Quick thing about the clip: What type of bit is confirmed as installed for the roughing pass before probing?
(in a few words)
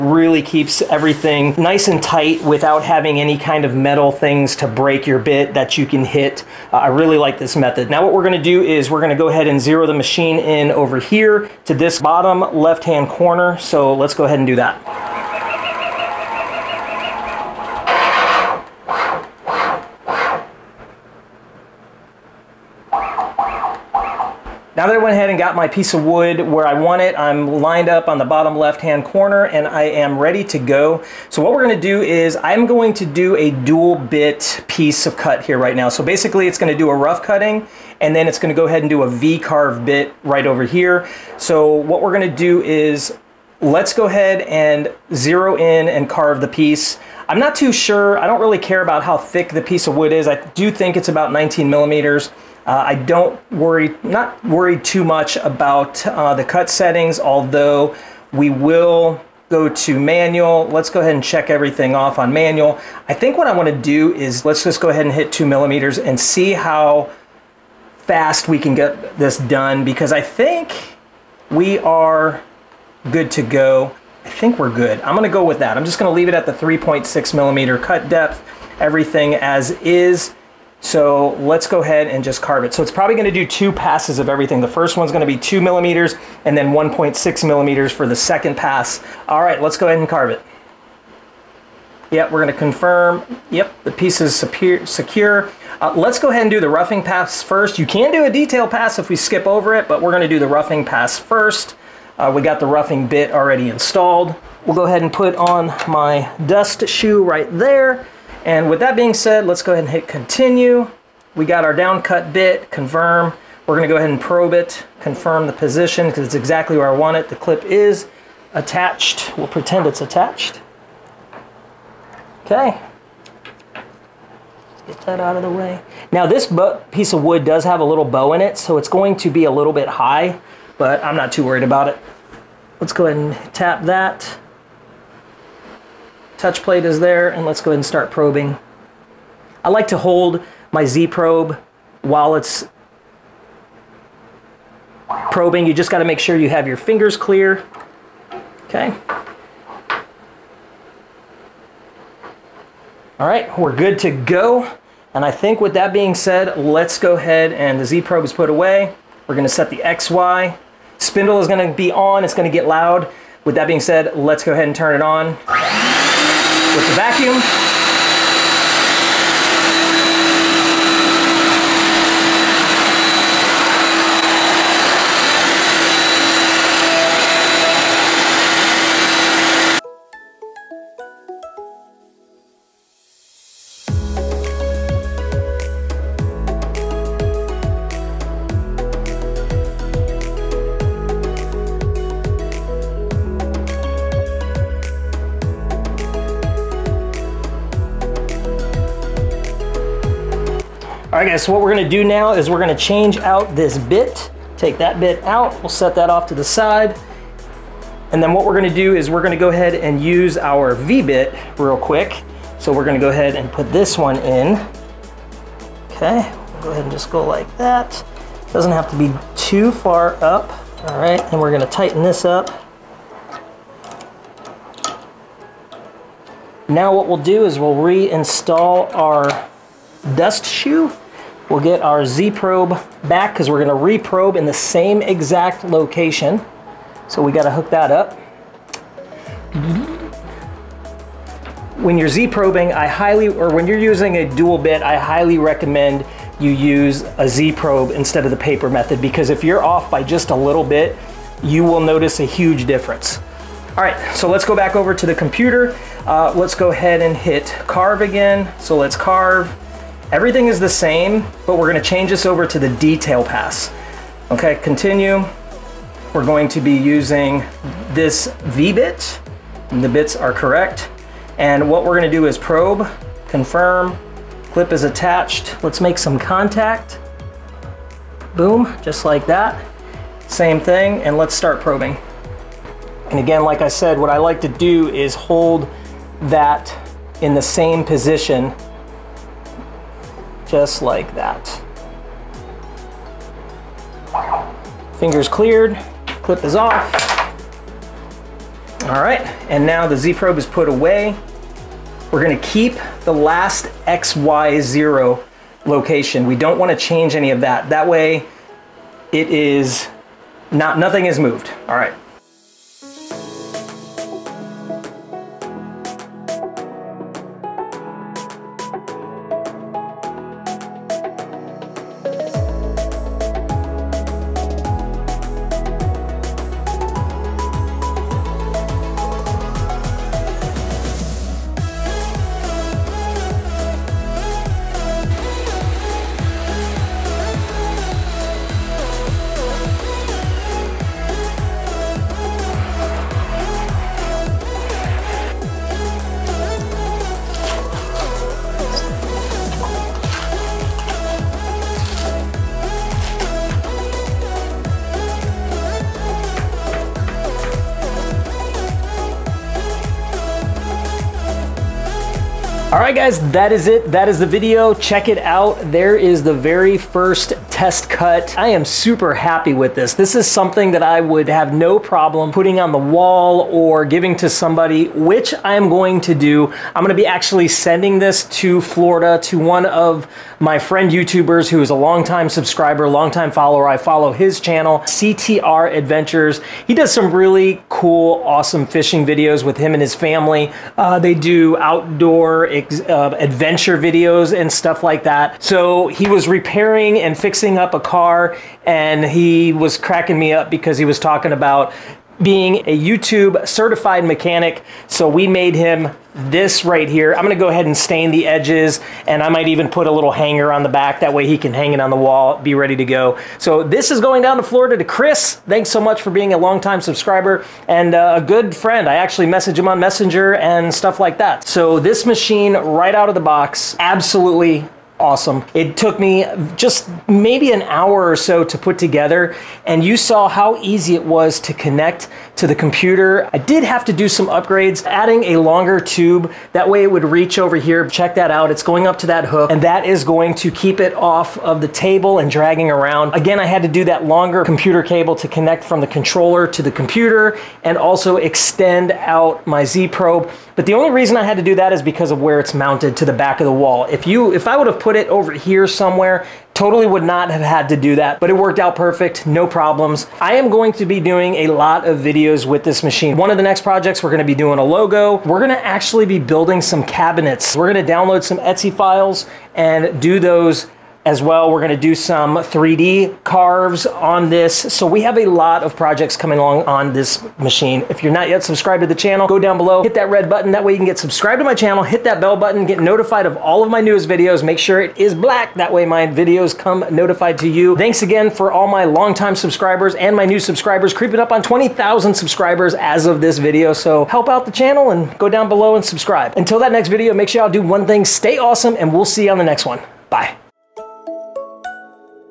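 Down cut bit.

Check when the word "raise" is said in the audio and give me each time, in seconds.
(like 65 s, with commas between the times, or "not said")
not said.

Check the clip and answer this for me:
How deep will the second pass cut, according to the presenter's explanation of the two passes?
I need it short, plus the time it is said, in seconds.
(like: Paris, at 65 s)
1.6 millimeters, at 86 s.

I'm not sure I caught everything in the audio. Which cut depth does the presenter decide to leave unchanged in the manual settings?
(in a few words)
3.6 millimeters.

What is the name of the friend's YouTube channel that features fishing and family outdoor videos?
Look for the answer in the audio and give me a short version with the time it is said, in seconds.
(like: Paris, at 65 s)
CTR Adventures, at 384 s.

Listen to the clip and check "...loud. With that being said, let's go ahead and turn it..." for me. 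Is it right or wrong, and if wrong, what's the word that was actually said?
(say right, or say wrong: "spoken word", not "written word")
right.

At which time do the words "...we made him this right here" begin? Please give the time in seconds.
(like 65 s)
405 s.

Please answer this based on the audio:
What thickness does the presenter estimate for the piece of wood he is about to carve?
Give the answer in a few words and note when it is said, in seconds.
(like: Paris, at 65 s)
19 millimeters, at 51 s.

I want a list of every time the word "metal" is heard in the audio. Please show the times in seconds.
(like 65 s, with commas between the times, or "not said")
3 s.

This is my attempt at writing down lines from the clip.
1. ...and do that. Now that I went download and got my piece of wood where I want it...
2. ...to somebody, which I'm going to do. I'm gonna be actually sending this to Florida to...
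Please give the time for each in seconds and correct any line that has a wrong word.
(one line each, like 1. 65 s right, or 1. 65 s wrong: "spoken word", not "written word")
1. 14 s wrong: "ahead", not "download"
2. 374 s right.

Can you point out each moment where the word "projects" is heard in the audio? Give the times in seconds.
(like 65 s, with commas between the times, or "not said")
463 s, 475 s.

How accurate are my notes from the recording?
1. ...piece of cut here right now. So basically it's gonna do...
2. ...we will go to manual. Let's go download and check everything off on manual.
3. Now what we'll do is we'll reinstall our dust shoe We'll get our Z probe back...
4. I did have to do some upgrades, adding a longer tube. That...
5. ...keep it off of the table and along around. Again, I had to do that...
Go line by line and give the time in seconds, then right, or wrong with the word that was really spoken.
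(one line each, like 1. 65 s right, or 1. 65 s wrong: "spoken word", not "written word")
1. 34 s right
2. 58 s wrong: "ahead", not "download"
3. 226 s right
4. 433 s right
5. 440 s wrong: "dragging", not "along".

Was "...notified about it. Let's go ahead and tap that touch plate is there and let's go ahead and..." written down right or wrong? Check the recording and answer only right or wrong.
wrong.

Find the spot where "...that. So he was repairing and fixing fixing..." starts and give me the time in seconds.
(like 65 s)
395 s.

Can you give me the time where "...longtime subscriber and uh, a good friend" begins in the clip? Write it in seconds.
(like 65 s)
416 s.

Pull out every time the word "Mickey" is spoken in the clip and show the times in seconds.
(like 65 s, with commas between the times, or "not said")
not said.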